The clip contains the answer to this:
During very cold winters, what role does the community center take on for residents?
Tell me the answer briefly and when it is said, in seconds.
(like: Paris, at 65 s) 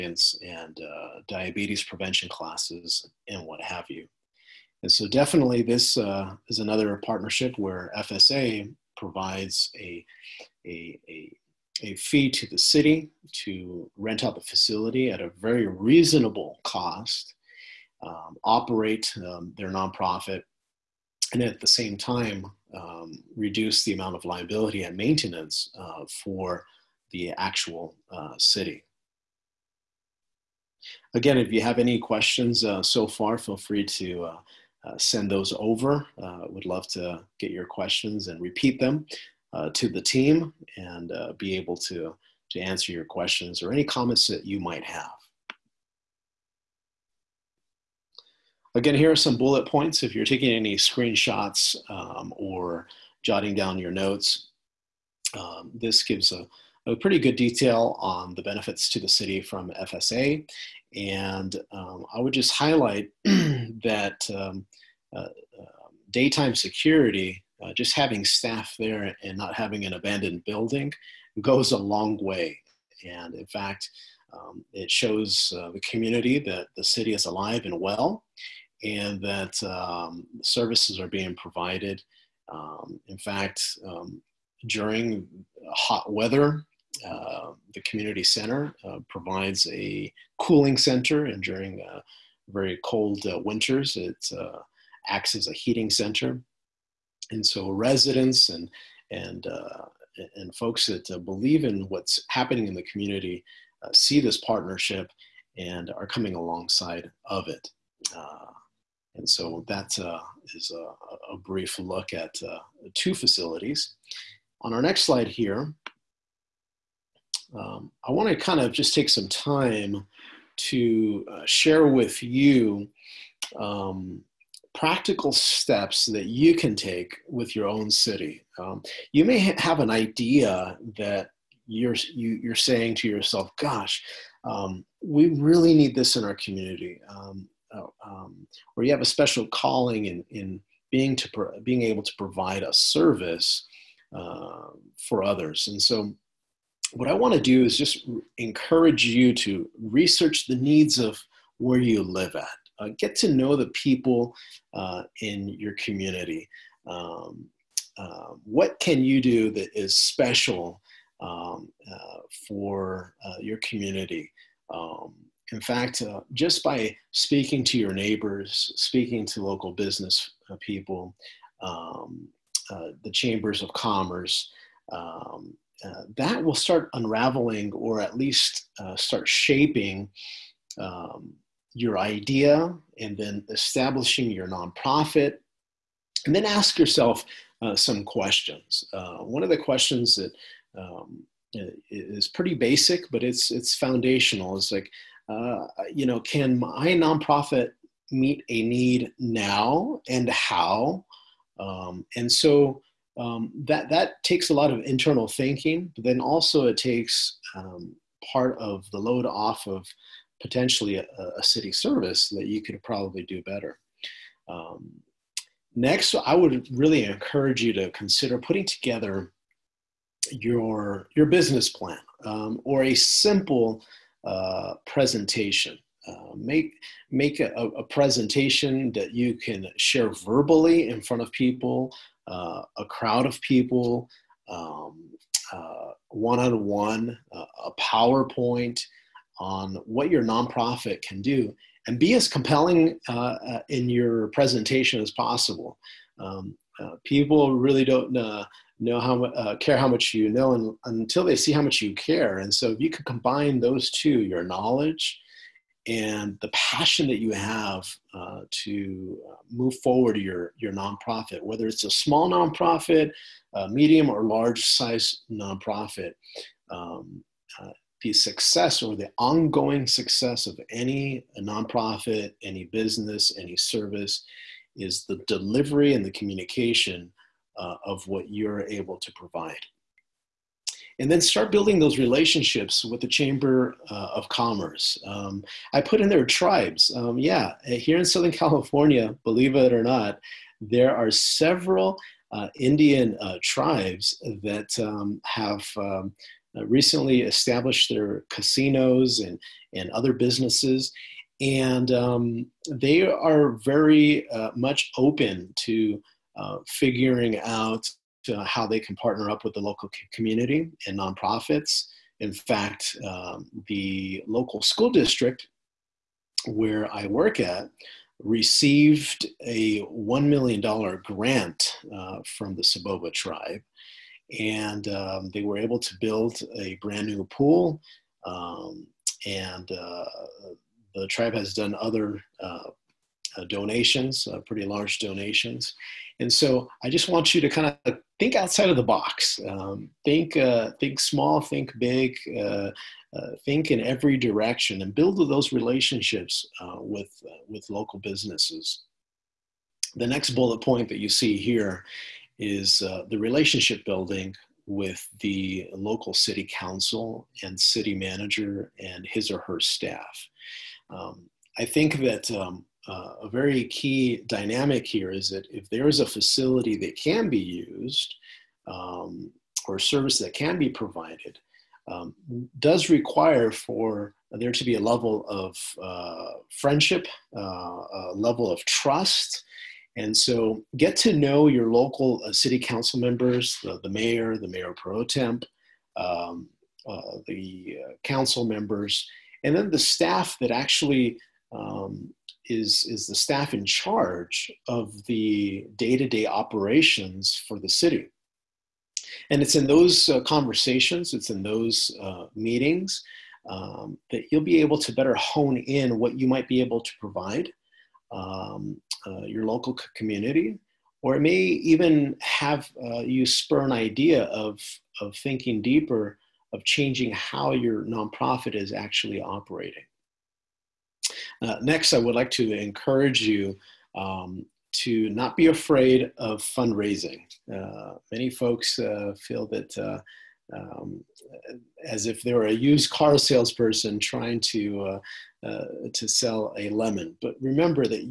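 heating center, at 95 s.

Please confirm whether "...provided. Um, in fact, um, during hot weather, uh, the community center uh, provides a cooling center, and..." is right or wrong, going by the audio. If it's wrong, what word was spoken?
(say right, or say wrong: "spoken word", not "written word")
right.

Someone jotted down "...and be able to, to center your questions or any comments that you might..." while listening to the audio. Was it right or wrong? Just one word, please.
wrong.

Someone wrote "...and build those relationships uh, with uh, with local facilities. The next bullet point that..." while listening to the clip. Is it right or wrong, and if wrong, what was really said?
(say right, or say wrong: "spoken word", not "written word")
wrong: "businesses", not "facilities".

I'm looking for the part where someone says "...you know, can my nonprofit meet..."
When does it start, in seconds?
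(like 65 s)
195 s.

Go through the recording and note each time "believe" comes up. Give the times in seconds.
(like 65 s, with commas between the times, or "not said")
101 s, 289 s.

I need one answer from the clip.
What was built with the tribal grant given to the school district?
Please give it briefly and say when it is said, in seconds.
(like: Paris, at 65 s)
a brand new pool, at 326 s.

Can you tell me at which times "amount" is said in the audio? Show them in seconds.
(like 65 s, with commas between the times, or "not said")
23 s.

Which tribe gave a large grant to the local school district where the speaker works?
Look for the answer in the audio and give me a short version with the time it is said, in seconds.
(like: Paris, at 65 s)
Soboba, at 322 s.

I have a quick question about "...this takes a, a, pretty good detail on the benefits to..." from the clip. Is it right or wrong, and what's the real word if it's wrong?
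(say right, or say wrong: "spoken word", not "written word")
wrong: "gives", not "takes".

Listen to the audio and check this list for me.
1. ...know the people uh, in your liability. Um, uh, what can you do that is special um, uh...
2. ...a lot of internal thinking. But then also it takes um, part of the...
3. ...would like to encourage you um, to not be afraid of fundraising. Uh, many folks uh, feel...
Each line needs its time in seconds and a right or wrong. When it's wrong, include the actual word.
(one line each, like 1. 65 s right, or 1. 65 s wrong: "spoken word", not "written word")
1. 153 s wrong: "community", not "liability"
2. 204 s right
3. 421 s right.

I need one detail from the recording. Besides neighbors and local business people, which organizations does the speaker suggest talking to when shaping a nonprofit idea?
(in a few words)
chambers of commerce.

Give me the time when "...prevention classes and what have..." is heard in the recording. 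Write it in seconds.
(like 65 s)
1 s.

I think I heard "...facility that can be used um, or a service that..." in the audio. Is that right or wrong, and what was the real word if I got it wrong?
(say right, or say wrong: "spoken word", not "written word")
right.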